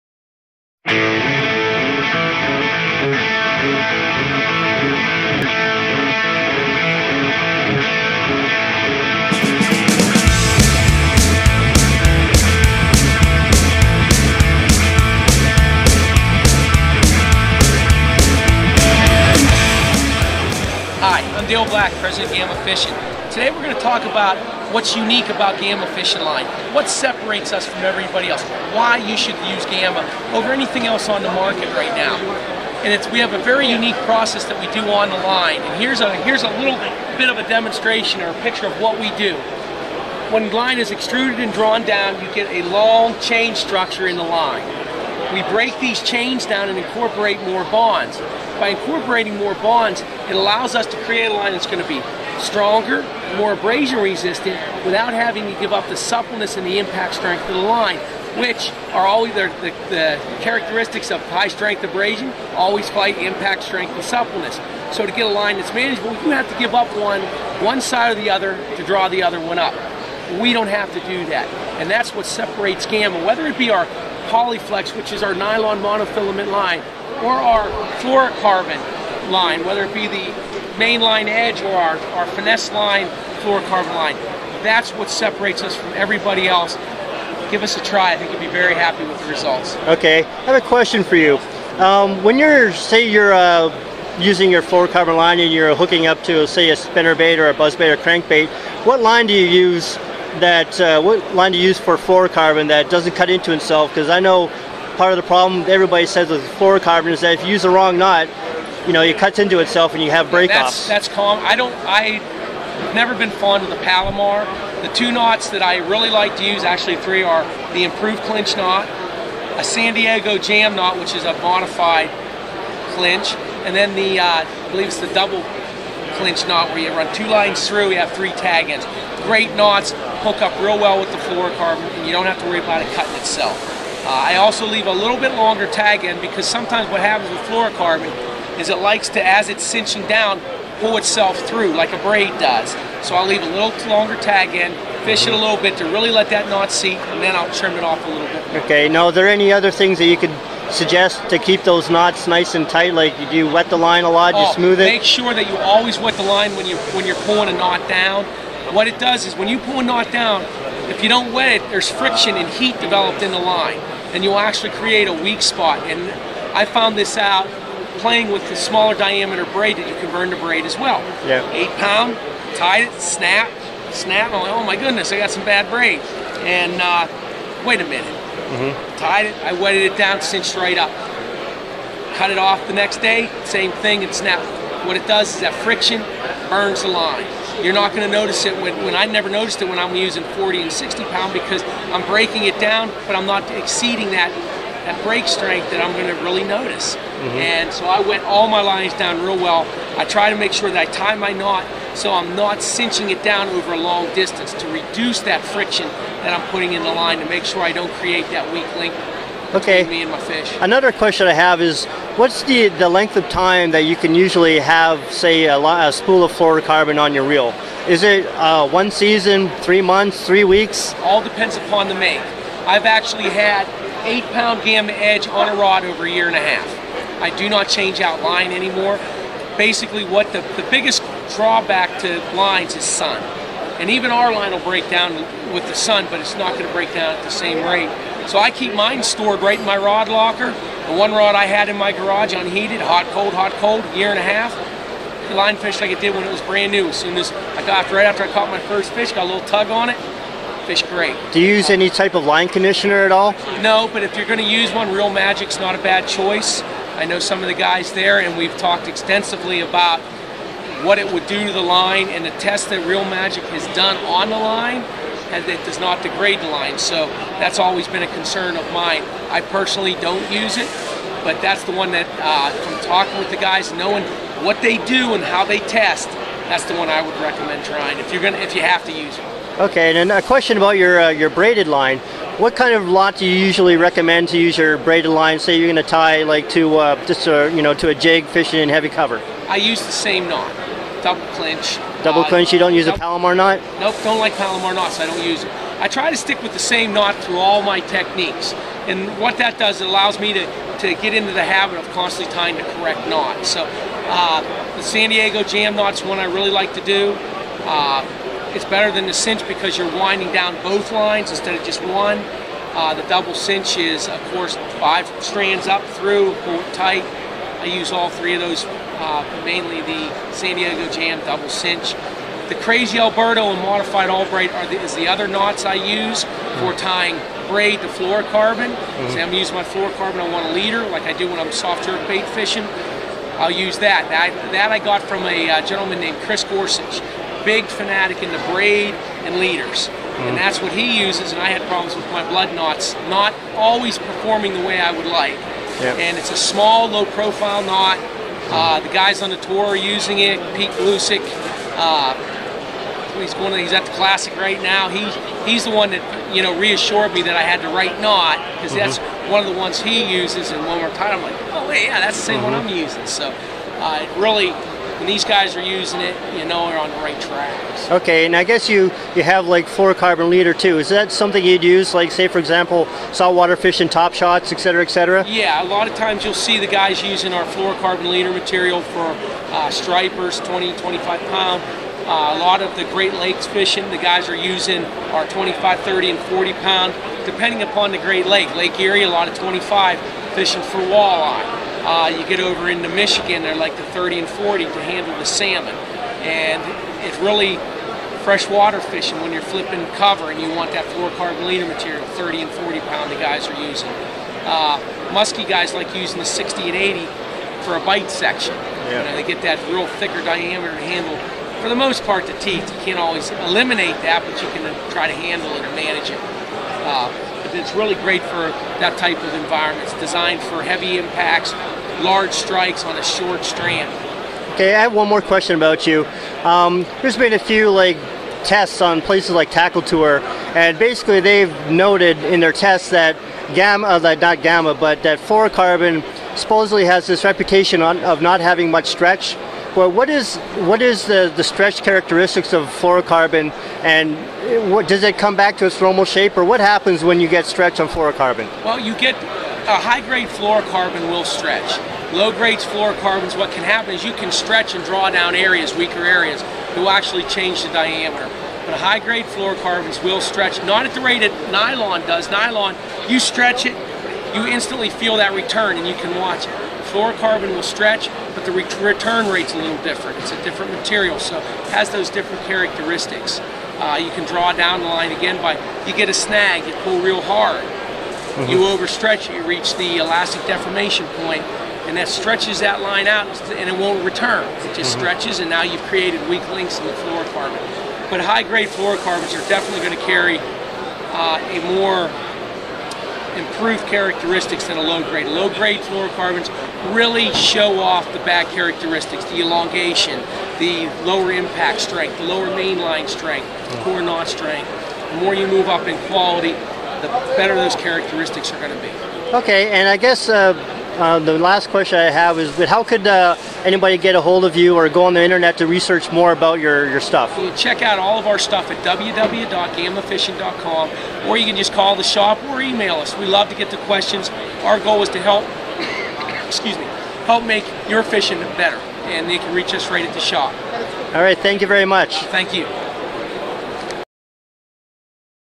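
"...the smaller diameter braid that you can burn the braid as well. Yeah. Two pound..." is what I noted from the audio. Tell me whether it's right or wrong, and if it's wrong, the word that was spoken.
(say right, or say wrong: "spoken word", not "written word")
wrong: "Eight", not "Two".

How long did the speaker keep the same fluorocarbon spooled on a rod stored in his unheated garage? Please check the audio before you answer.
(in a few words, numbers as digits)
A year and a half.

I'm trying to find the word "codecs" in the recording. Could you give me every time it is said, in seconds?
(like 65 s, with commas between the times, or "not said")
not said.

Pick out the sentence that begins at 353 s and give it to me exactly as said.
To, he's at the classic right now.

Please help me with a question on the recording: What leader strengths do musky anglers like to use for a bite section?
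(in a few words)
60 and 80 pound.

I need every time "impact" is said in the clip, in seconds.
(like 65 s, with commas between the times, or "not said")
56 s, 63 s, 420 s, 501 s.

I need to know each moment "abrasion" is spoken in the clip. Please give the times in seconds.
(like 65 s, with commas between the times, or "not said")
53 s, 61 s.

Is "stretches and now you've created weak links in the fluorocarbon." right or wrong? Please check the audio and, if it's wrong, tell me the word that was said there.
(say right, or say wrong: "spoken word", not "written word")
right.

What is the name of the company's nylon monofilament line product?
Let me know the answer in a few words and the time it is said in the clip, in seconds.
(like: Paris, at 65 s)
Polyflex, at 74 s.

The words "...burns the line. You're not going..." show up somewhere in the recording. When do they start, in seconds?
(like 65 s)
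186 s.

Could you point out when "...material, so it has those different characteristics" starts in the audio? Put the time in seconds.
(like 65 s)
470 s.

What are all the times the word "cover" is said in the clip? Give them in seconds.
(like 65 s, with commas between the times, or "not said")
288 s, 399 s.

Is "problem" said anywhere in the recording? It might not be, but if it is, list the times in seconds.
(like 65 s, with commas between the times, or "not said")
105 s, 341 s.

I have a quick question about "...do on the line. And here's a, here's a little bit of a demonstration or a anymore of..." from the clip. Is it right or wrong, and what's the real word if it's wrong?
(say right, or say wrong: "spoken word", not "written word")
wrong: "picture", not "anymore".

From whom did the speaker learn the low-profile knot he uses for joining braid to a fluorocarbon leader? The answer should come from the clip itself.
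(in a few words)
Chris Gorsuch.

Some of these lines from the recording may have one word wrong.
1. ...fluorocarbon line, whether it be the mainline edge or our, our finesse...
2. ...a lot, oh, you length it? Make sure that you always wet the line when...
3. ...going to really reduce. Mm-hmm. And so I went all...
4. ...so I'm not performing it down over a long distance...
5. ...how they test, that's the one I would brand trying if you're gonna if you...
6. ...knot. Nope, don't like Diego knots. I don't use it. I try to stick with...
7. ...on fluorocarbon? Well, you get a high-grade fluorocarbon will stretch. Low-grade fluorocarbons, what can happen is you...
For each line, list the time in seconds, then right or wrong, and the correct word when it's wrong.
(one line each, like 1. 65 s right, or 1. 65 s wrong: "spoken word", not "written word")
1. 77 s right
2. 154 s wrong: "smooth", not "length"
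3. 195 s wrong: "notice", not "reduce"
4. 201 s wrong: "cinching", not "performing"
5. 275 s wrong: "recommend", not "brand"
6. 293 s wrong: "Palomar", not "Diego"
7. 447 s right.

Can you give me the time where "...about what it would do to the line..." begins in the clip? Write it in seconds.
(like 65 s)
259 s.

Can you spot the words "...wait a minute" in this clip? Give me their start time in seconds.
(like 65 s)
177 s.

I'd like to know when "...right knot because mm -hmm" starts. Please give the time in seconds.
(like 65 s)
357 s.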